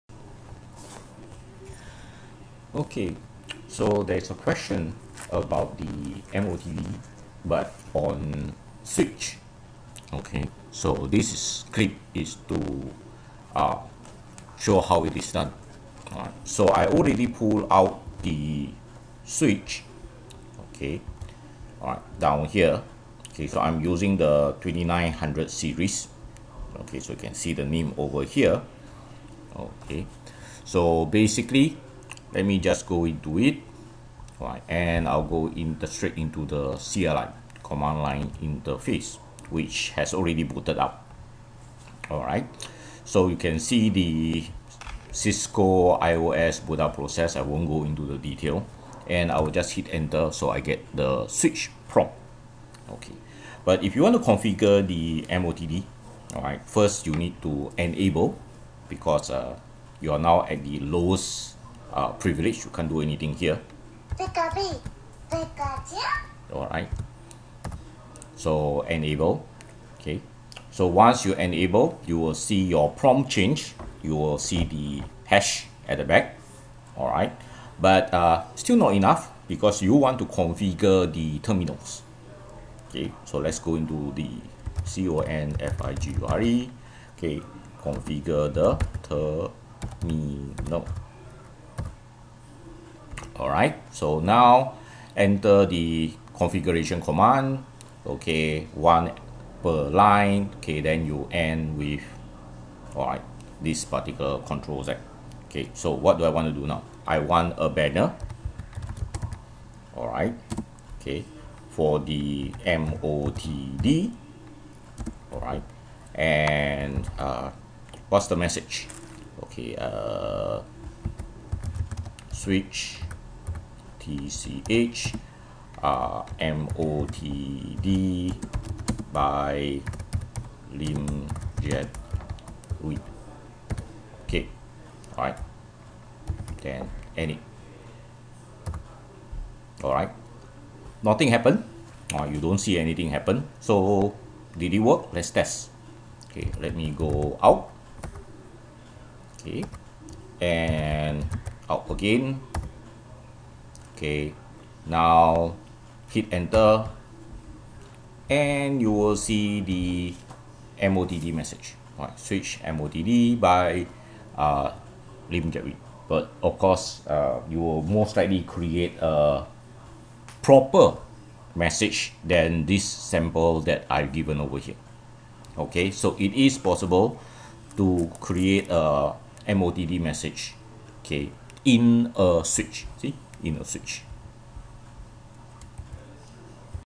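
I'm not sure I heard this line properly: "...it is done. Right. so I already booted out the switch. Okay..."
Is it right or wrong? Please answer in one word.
wrong.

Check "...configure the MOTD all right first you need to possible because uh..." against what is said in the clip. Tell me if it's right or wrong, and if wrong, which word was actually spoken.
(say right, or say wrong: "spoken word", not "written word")
wrong: "enable", not "possible".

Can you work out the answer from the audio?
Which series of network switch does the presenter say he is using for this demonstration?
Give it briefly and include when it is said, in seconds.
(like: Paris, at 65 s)
2900 series, at 24 s.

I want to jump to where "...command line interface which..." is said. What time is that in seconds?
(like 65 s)
37 s.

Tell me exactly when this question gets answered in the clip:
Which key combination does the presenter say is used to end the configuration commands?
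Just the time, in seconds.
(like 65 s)
104 s.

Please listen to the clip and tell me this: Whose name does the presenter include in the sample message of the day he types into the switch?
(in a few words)
Lim Jet Wee.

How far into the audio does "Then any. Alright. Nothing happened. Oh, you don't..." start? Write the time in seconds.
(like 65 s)
136 s.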